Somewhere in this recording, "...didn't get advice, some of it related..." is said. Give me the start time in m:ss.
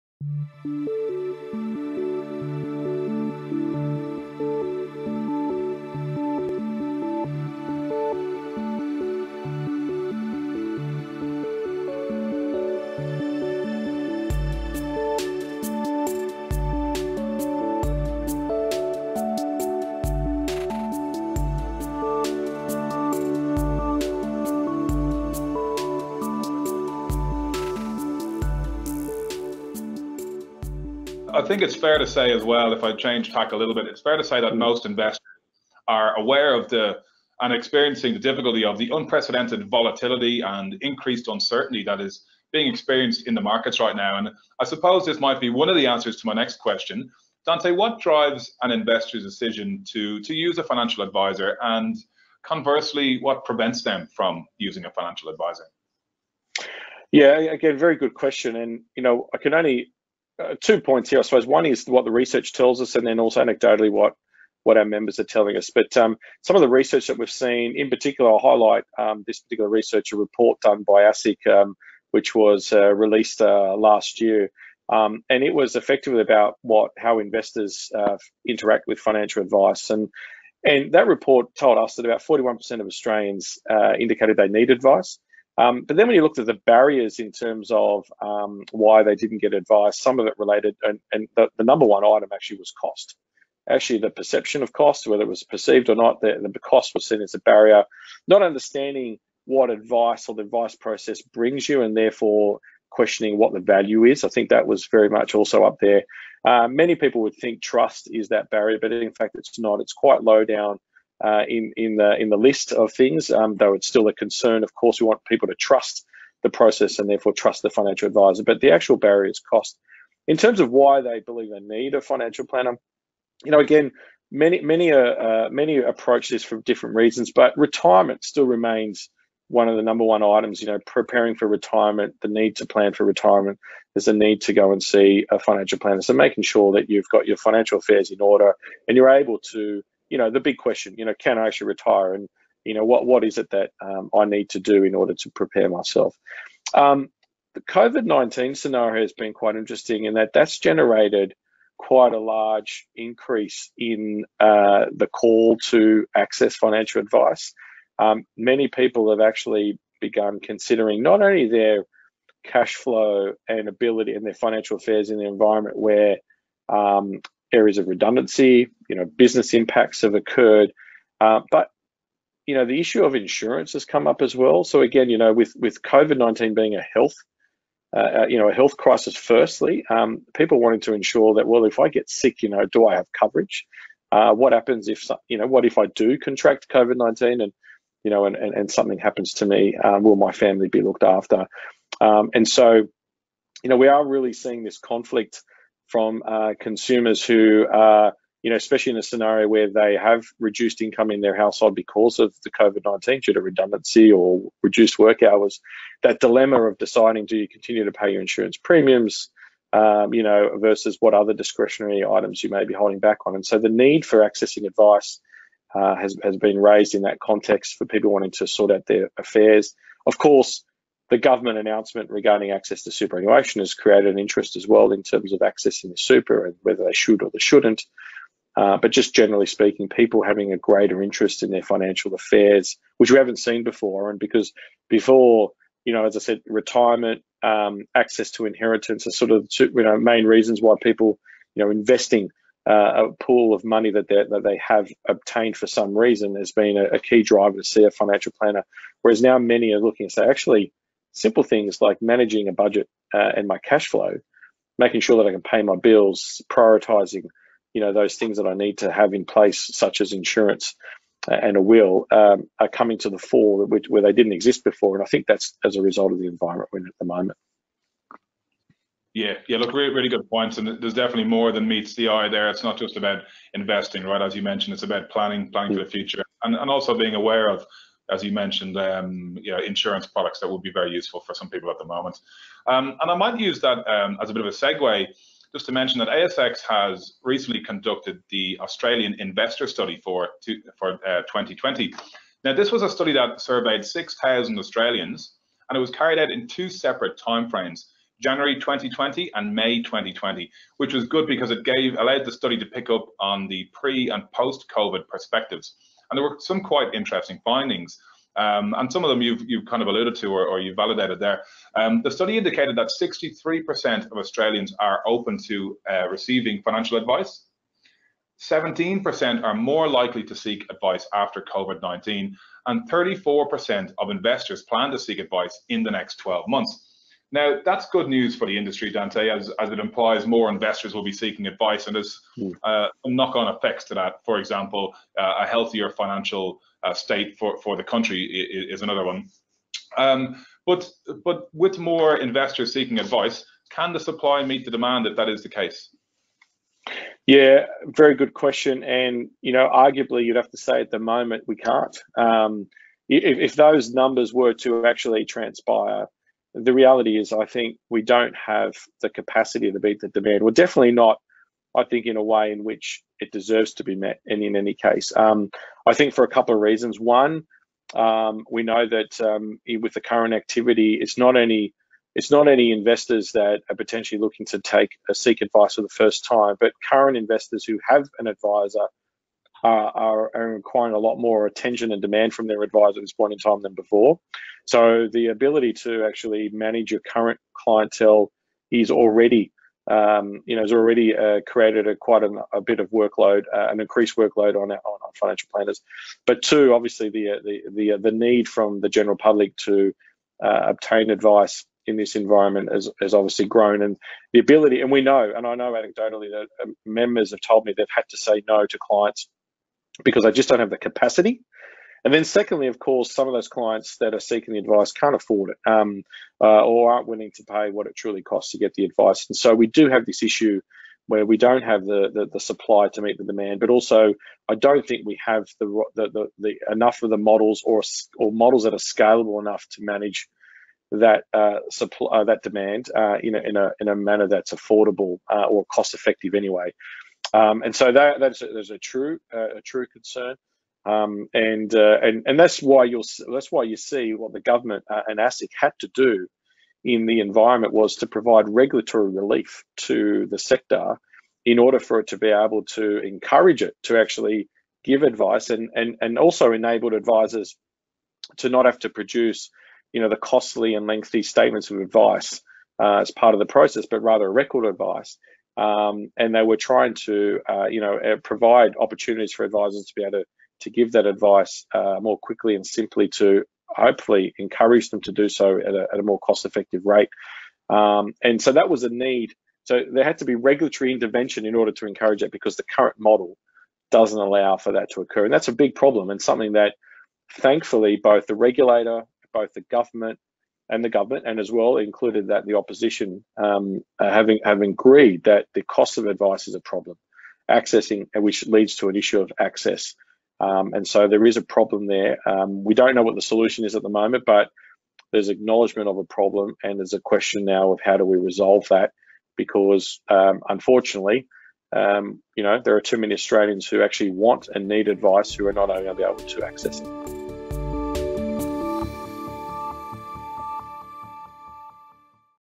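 1:29.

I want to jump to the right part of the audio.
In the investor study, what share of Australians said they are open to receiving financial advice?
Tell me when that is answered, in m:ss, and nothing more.
5:13.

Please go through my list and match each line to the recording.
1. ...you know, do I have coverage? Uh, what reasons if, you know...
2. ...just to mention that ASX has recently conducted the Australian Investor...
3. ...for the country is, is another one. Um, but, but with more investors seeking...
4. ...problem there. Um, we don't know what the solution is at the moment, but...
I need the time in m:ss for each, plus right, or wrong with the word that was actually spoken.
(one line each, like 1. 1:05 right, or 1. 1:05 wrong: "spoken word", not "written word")
1. 3:02 wrong: "happens", not "reasons"
2. 4:45 right
3. 5:37 right
4. 8:21 right.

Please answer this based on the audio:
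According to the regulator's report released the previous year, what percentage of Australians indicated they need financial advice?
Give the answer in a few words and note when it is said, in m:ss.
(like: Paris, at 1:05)
41%, at 1:22.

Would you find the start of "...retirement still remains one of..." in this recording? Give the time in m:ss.
2:07.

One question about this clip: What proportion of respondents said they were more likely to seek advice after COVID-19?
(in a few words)
17%.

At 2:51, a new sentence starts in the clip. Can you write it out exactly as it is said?
Uh, but, you know, the issue of insurance has come up as well.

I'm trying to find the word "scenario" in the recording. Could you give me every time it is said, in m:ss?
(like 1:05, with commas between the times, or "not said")
2:28, 3:19.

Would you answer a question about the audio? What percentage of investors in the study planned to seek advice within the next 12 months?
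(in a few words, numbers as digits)
34%.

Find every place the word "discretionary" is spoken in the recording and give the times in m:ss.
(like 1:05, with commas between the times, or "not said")
3:31.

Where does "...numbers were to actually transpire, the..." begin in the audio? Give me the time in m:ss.
5:53.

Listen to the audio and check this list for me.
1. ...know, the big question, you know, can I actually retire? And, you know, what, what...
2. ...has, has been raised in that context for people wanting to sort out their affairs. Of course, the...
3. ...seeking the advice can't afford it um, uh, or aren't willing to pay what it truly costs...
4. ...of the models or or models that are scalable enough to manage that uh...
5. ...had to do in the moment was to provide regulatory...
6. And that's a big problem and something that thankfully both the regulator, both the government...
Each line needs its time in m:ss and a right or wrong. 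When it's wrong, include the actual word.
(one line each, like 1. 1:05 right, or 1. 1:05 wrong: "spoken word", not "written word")
1. 2:20 right
2. 3:35 right
3. 6:54 right
4. 7:07 right
5. 7:25 wrong: "environment", not "moment"
6. 8:05 right.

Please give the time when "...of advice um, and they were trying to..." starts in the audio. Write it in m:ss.
7:44.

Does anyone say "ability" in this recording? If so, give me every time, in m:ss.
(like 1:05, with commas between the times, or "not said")
2:43, 6:25, 6:44.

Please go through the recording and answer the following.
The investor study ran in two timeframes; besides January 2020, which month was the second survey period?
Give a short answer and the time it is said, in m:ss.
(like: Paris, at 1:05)
May 2020, at 4:59.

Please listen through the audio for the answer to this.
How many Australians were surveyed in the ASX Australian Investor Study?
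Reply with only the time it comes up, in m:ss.
4:53.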